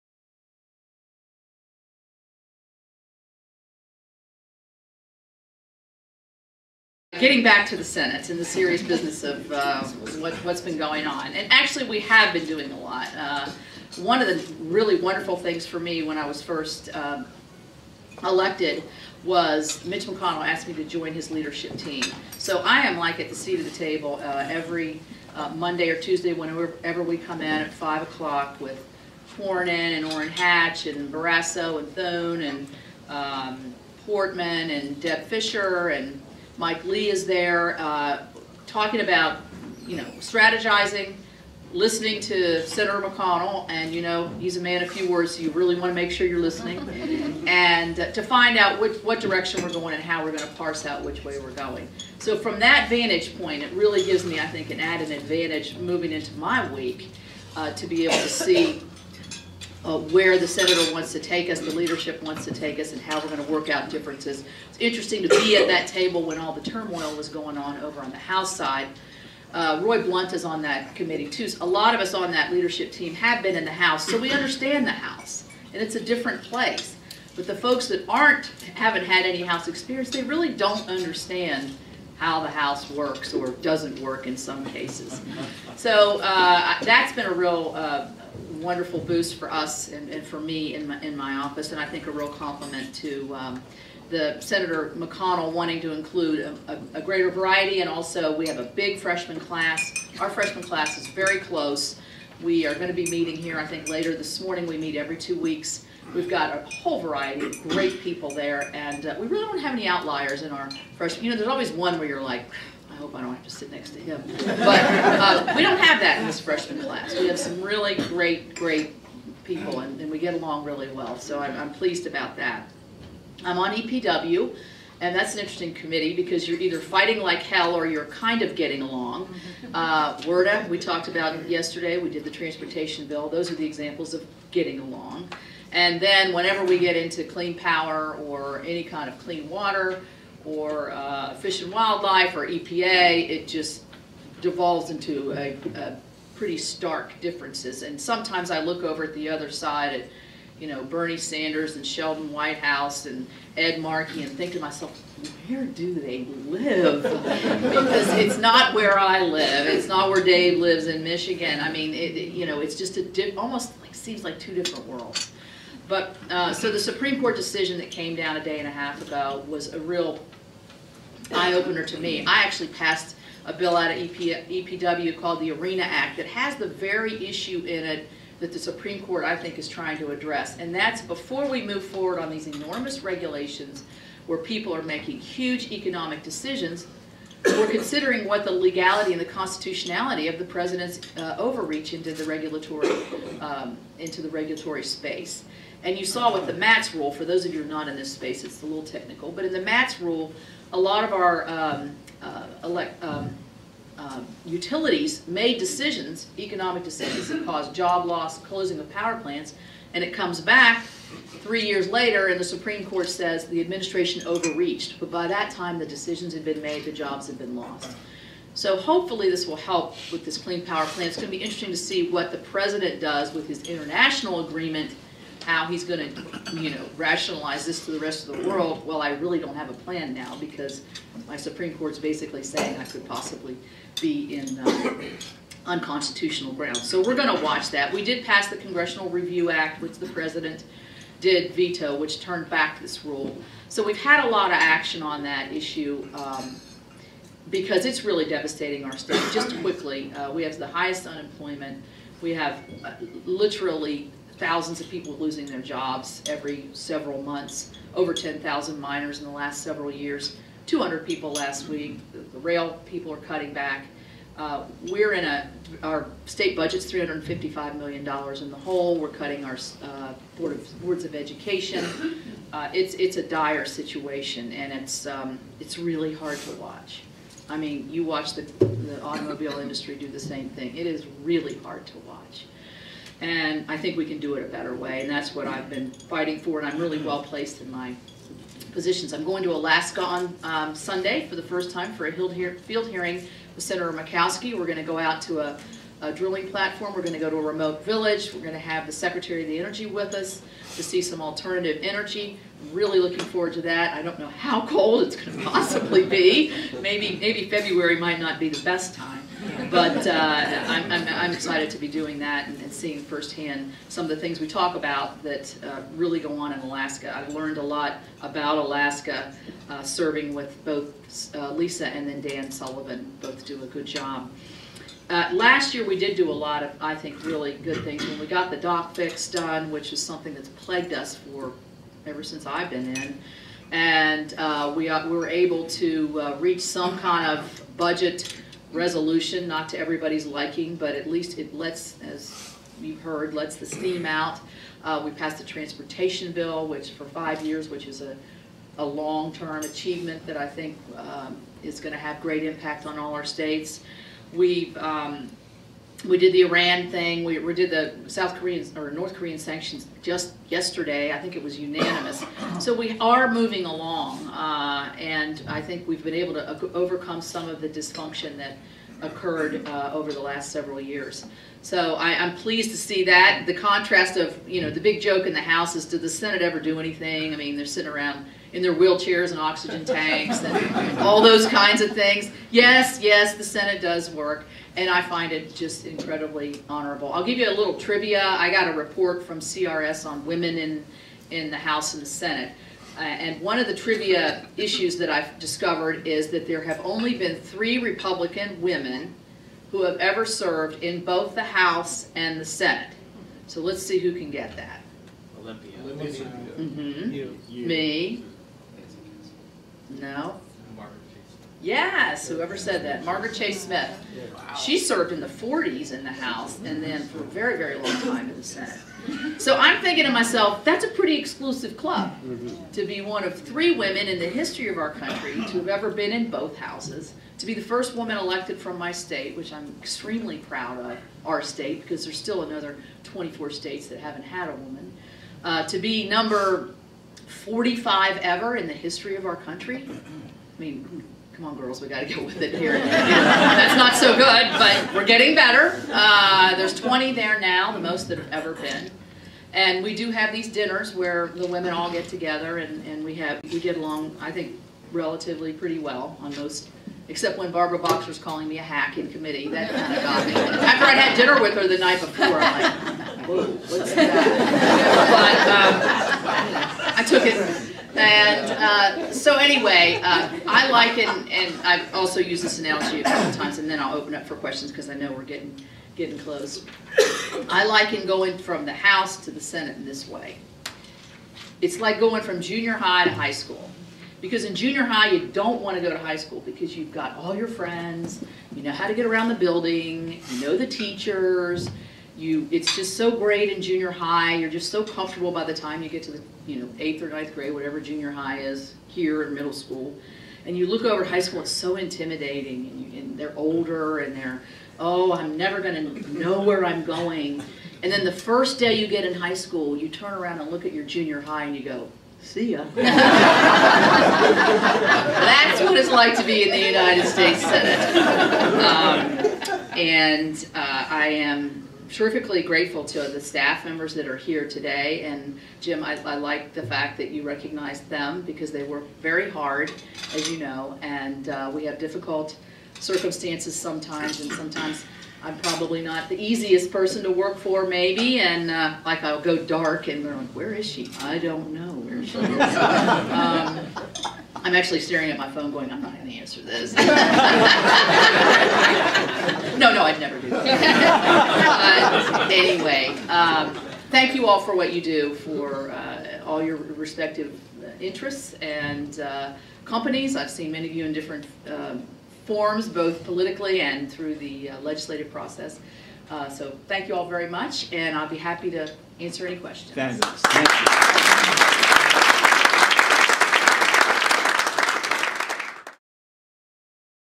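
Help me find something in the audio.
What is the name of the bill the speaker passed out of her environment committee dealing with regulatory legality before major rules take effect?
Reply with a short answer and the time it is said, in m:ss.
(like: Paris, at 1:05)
ARENA Act, at 2:55.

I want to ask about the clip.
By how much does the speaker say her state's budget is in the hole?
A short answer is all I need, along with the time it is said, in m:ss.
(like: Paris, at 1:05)
$355 million, at 4:26.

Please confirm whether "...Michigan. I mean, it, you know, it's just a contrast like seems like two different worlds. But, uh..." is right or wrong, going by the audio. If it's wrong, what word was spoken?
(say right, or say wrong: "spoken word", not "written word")
wrong: "almost", not "contrast".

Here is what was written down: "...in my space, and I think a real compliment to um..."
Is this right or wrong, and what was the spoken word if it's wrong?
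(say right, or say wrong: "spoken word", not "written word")
wrong: "office", not "space".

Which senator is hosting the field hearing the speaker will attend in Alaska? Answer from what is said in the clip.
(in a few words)
Senator Murkowski.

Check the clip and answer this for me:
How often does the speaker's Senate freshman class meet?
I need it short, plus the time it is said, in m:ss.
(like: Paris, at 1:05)
every two weeks, at 1:44.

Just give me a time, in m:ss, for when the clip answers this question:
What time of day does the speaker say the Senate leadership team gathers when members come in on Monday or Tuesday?
0:27.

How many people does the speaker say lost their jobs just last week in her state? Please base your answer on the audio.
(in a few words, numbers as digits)
200.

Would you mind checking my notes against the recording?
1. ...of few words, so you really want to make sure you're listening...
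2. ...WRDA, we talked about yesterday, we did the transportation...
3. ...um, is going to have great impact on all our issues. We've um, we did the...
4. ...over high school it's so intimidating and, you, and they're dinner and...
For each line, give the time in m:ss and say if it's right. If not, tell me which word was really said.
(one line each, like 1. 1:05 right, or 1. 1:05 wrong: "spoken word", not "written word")
1. 0:44 right
2. 2:10 right
3. 5:50 wrong: "states", not "issues"
4. 8:20 wrong: "older", not "dinner".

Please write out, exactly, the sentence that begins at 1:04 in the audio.
It's interesting to be at that table when all the turmoil was going on over on the House side.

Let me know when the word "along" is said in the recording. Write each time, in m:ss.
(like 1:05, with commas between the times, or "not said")
2:00, 2:08, 2:14, 6:03, 7:33.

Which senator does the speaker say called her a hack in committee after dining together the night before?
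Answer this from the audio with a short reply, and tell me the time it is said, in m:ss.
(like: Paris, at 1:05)
Barbara Boxer, at 7:37.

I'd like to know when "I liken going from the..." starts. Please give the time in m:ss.
7:57.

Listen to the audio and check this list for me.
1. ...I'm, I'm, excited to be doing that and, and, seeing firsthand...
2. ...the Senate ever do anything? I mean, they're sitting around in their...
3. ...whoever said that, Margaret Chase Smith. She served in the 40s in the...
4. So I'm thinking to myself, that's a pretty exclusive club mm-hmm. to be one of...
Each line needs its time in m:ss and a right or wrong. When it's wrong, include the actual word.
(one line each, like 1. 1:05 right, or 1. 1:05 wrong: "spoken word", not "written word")
1. 5:10 right
2. 6:16 right
3. 6:52 right
4. 6:59 right.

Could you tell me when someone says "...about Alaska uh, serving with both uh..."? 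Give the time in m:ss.
5:18.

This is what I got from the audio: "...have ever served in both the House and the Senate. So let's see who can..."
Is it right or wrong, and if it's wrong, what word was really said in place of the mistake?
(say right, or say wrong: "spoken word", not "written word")
right.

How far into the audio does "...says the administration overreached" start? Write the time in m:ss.
3:33.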